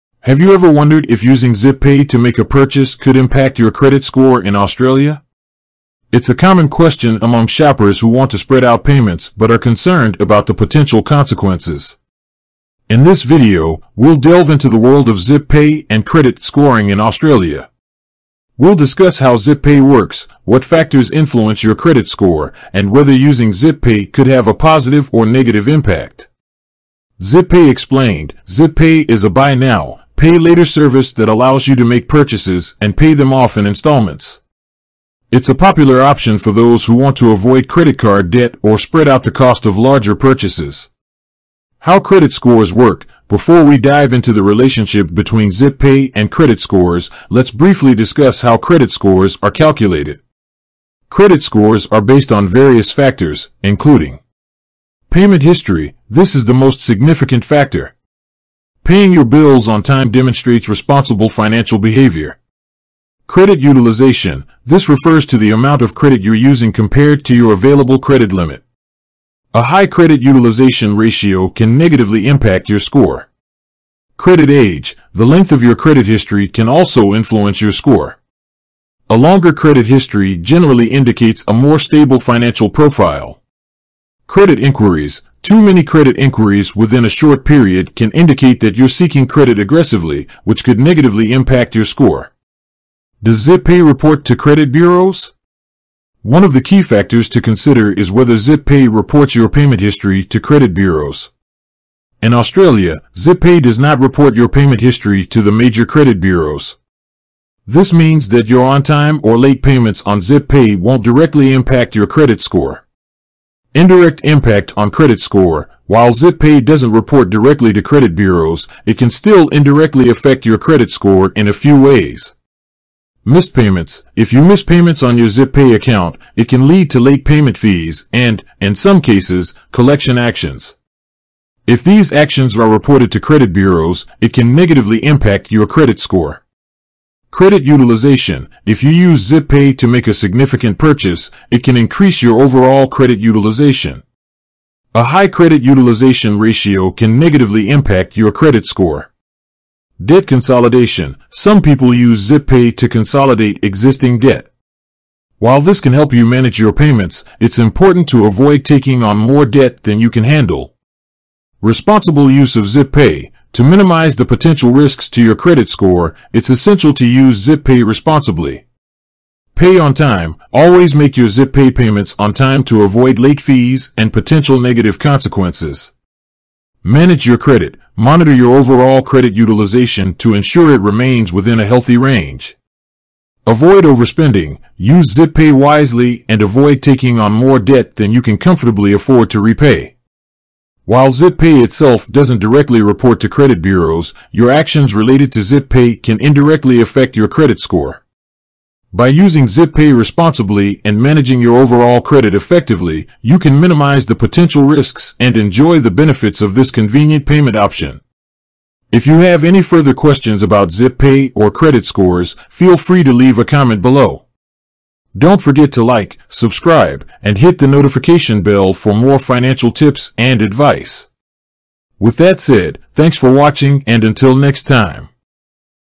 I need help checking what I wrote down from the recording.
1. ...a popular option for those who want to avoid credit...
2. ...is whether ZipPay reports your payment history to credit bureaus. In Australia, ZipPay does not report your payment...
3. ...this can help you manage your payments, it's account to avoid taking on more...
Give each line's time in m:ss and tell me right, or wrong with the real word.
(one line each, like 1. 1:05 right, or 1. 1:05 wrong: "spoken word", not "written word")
1. 0:35 right
2. 1:37 right
3. 2:35 wrong: "important", not "account".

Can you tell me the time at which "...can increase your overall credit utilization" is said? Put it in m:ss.
2:21.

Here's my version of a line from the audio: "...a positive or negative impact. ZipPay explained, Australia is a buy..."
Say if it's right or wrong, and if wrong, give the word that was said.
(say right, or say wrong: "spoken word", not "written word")
wrong: "ZipPay", not "Australia".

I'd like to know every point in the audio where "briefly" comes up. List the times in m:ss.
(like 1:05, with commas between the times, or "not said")
0:47.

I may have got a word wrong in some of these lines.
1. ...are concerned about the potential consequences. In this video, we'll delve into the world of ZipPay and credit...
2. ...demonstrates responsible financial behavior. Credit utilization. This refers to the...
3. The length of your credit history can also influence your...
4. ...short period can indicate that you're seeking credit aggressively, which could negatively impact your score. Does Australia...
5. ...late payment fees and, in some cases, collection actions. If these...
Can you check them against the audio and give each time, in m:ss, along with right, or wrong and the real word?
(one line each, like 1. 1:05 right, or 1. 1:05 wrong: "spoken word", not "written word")
1. 0:09 right
2. 1:00 right
3. 1:15 right
4. 1:27 wrong: "ZipPay", not "Australia"
5. 2:06 right.